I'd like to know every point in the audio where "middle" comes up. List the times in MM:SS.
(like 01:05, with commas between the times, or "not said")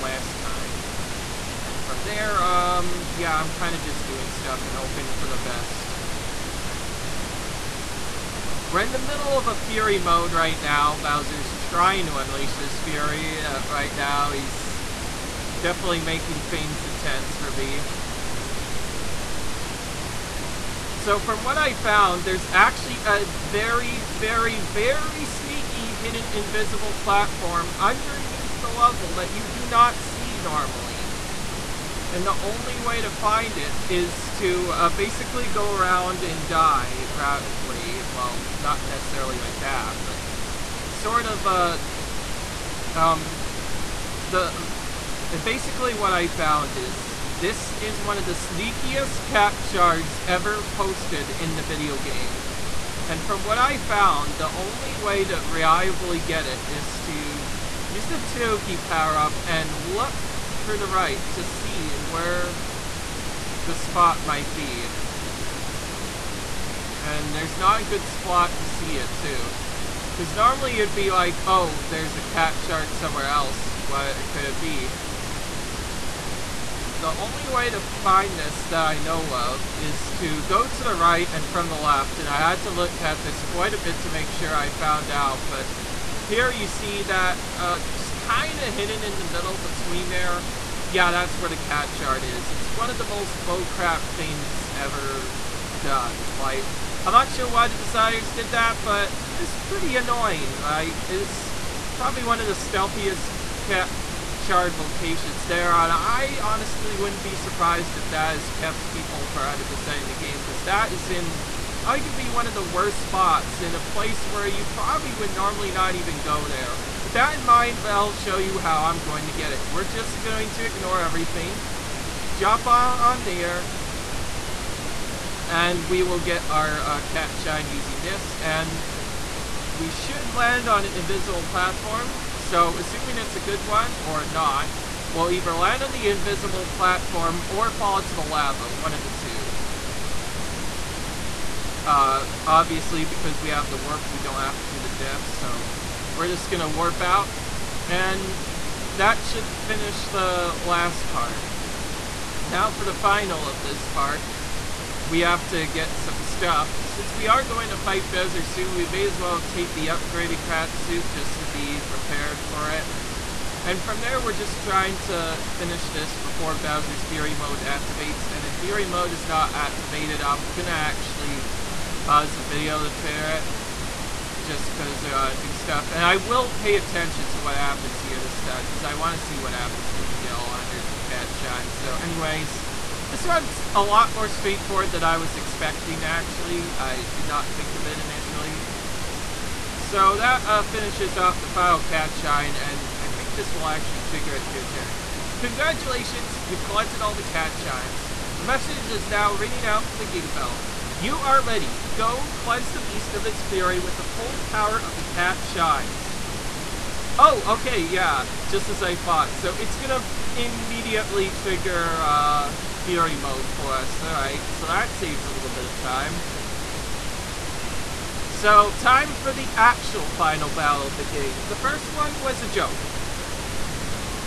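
00:08, 01:29.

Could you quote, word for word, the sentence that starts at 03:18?
A message is now ringing out for the Gigabell.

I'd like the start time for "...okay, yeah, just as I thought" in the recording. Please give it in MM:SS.
03:27.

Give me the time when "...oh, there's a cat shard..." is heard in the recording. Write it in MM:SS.
01:11.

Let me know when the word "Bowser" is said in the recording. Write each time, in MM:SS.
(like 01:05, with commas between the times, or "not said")
00:10, 02:38, 02:46.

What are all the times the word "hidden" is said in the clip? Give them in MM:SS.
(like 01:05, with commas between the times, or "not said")
00:25, 01:28.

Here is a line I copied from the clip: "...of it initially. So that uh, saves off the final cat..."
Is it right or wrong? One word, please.
wrong.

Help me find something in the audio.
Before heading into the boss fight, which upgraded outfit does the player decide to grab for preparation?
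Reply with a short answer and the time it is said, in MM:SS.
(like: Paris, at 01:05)
Krat suit, at 02:40.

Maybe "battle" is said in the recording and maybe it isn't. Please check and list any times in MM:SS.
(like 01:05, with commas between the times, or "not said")
03:40.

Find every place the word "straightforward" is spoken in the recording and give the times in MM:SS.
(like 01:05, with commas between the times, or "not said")
03:04.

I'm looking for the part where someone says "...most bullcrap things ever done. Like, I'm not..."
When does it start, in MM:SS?
01:33.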